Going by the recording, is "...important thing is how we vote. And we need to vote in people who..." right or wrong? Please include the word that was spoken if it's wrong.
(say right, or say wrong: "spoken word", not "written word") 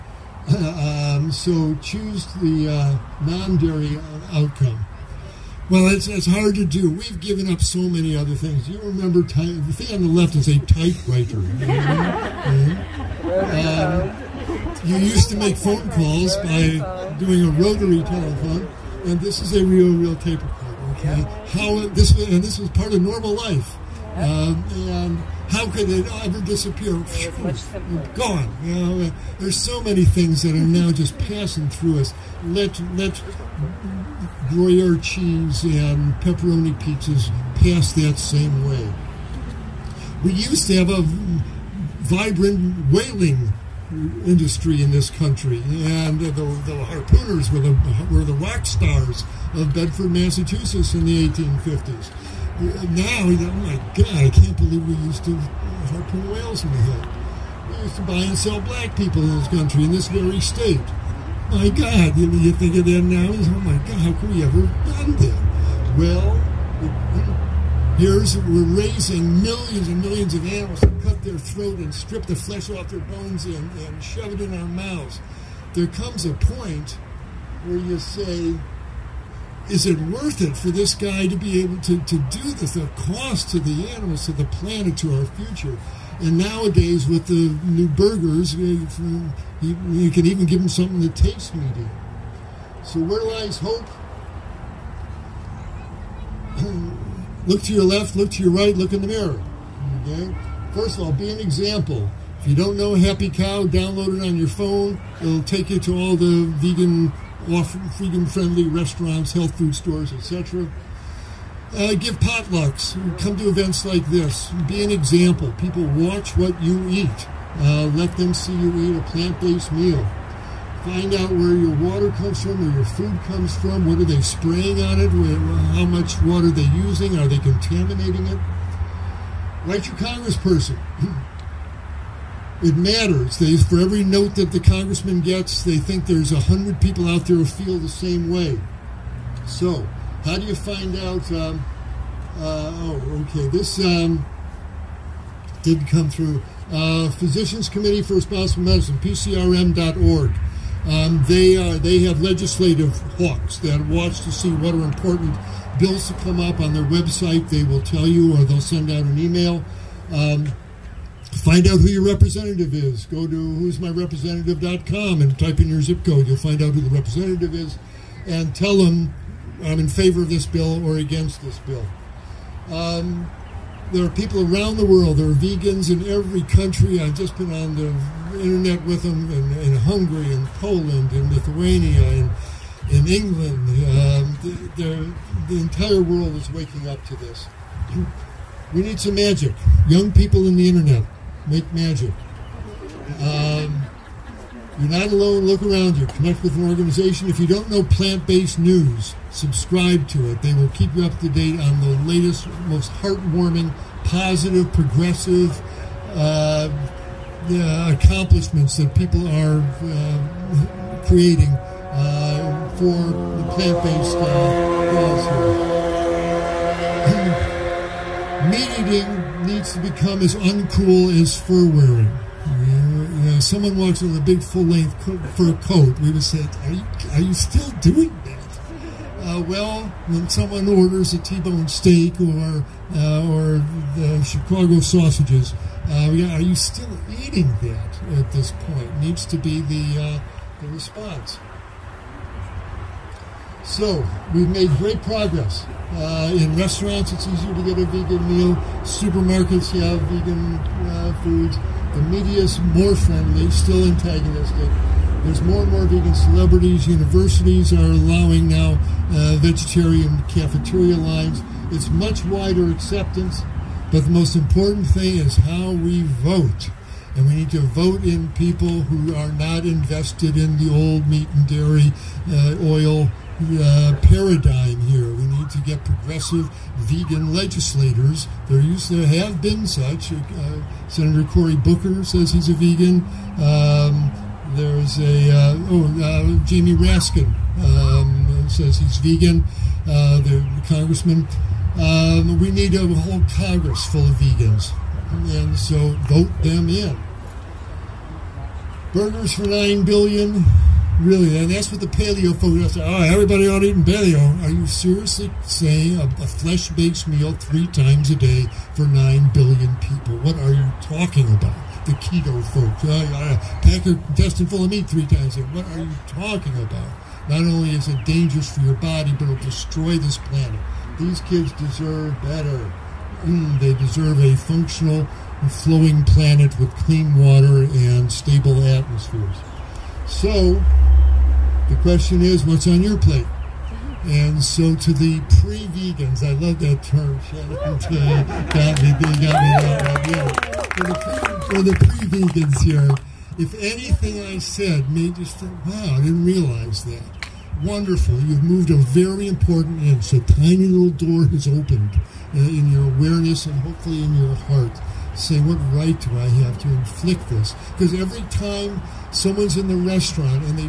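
right.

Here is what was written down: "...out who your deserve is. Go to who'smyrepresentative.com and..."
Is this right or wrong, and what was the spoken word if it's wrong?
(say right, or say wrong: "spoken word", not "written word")
wrong: "representative", not "deserve".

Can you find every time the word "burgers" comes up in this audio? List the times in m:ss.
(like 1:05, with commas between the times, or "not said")
1:27, 4:58.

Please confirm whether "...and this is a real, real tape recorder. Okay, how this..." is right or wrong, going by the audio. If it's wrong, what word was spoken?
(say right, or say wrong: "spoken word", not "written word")
right.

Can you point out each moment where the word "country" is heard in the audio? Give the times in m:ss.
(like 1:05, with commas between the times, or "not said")
0:45, 0:59, 2:56.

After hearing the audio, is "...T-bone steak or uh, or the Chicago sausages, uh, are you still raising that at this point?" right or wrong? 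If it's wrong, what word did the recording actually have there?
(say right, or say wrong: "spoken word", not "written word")
wrong: "eating", not "raising".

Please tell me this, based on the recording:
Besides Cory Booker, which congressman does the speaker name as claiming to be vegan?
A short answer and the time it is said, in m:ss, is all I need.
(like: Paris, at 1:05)
Jamie Raskin, at 4:46.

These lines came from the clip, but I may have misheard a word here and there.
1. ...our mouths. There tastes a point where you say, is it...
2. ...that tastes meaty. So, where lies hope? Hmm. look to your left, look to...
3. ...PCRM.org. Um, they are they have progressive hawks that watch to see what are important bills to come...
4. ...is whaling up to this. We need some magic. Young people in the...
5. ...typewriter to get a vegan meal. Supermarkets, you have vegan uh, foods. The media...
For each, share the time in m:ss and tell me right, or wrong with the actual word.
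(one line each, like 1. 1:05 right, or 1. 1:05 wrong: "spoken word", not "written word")
1. 1:14 wrong: "comes", not "tastes"
2. 1:31 right
3. 2:28 wrong: "legislative", not "progressive"
4. 3:06 wrong: "waking", not "whaling"
5. 4:07 wrong: "easier", not "typewriter".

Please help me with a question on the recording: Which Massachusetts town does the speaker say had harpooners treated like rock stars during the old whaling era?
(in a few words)
Bedford.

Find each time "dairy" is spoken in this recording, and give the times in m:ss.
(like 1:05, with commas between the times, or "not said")
0:03, 4:31.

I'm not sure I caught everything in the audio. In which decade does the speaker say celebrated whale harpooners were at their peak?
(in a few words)
1850s.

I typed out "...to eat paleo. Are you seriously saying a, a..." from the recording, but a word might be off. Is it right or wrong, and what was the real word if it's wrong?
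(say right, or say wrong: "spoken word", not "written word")
right.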